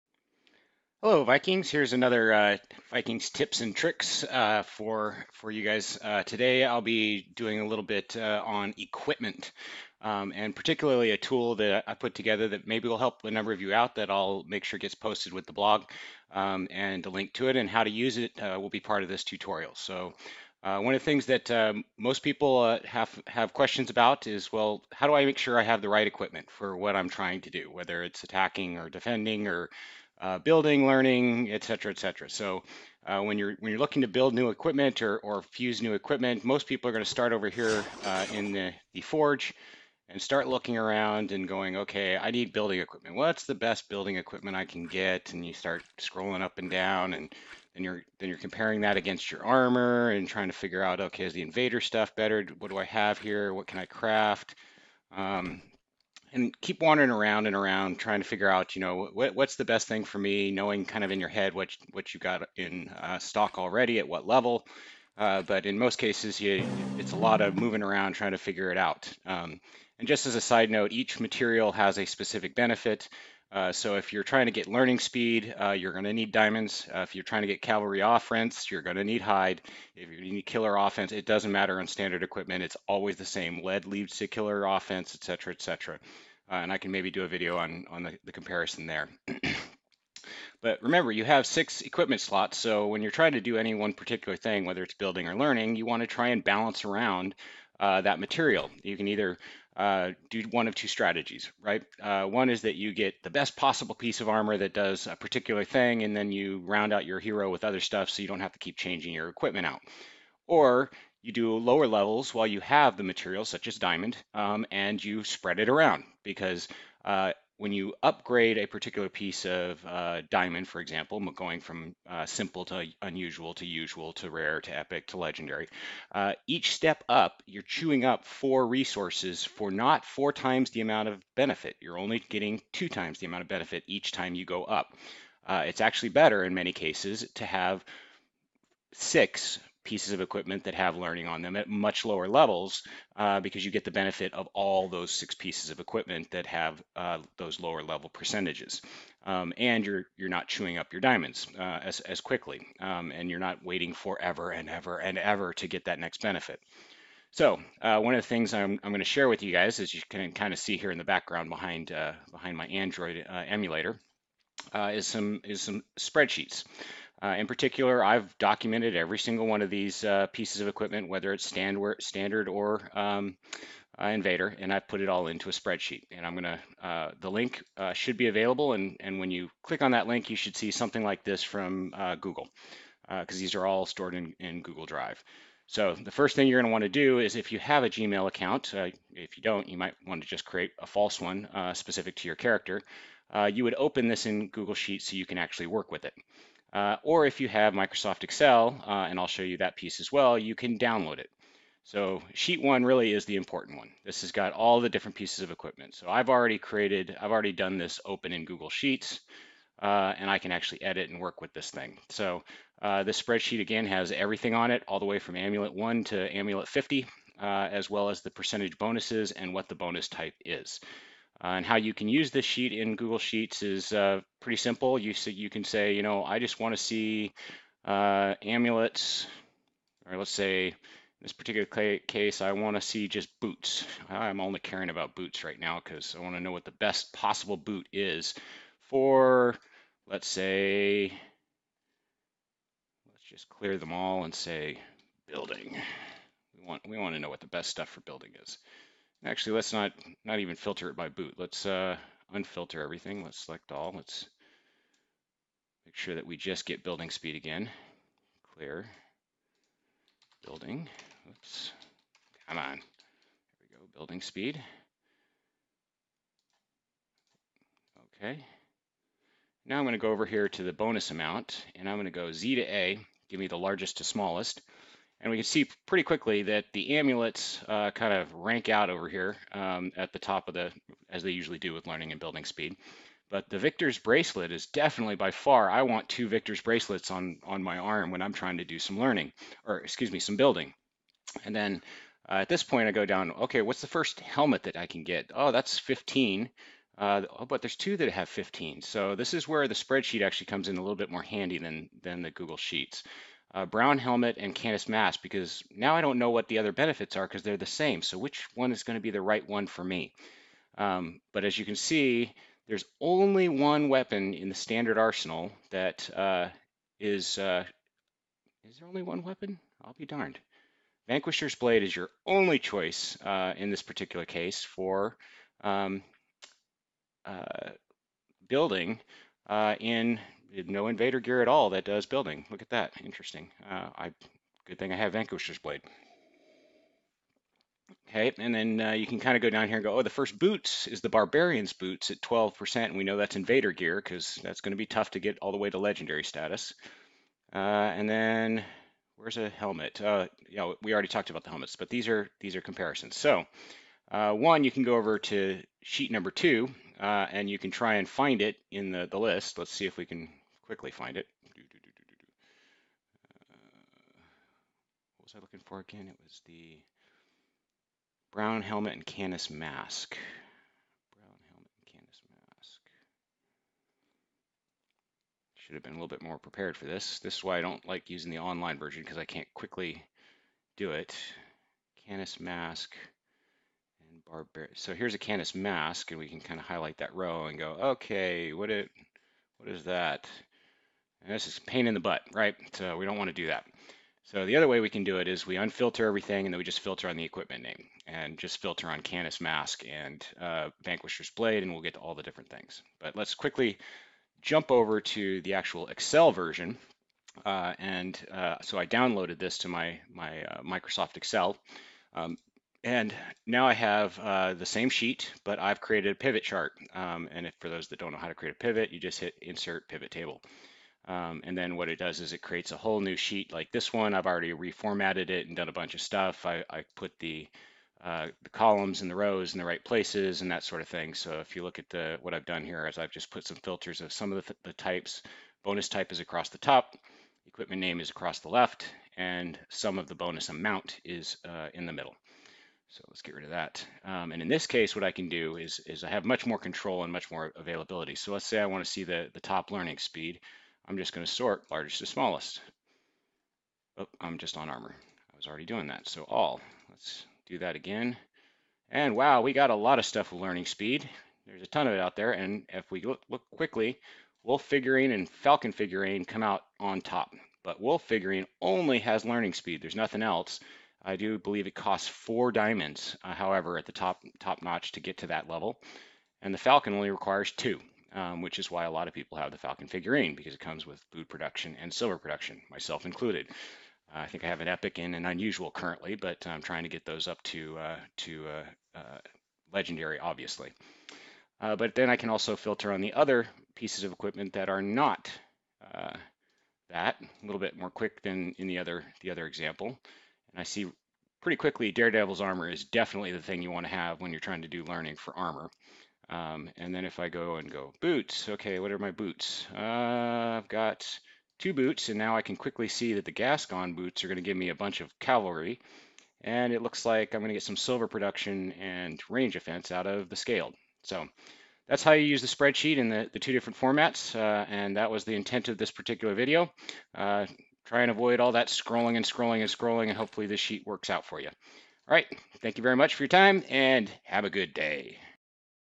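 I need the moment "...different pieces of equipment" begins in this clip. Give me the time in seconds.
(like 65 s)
204 s.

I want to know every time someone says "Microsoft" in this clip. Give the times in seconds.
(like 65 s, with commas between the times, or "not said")
197 s, 410 s.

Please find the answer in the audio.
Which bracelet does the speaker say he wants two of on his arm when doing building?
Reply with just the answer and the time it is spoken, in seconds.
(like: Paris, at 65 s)
Victor's bracelet, at 283 s.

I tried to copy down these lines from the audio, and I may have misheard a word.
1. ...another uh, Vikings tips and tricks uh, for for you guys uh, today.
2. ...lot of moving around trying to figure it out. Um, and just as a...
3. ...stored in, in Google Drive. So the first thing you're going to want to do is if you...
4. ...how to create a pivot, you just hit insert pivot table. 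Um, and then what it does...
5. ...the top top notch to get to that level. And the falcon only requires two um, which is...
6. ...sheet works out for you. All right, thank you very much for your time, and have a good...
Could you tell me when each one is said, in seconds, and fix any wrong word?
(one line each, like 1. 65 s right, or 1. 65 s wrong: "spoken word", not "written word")
1. 1 s right
2. 67 s right
3. 183 s right
4. 418 s right
5. 473 s right
6. 530 s right.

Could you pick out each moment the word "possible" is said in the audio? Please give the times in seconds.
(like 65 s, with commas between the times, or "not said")
103 s, 237 s.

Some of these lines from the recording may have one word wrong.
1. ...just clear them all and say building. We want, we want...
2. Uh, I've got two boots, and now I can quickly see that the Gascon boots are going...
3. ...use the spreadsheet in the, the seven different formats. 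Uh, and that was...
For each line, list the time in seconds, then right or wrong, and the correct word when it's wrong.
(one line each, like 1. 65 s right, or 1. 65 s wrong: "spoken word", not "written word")
1. 243 s right
2. 509 s right
3. 522 s wrong: "two", not "seven".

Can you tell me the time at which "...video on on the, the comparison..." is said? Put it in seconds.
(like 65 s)
87 s.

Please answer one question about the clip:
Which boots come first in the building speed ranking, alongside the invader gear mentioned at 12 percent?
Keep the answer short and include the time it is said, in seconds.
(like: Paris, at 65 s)
Barbarian's boots, at 341 s.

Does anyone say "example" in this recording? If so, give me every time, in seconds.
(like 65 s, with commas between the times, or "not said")
120 s, 499 s.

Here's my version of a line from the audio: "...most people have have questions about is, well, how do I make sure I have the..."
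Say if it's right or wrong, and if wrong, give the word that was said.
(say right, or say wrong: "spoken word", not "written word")
right.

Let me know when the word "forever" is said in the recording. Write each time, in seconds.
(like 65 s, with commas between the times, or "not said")
153 s.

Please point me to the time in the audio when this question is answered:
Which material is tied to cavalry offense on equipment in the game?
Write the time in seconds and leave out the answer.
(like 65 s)
79 s.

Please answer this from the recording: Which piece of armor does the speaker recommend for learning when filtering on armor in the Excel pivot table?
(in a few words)
Daredevil's armor.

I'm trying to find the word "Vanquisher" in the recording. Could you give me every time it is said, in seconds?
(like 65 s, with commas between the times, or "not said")
321 s, 335 s, 400 s.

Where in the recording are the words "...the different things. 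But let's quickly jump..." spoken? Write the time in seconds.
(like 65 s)
402 s.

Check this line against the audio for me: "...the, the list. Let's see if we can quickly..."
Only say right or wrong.
right.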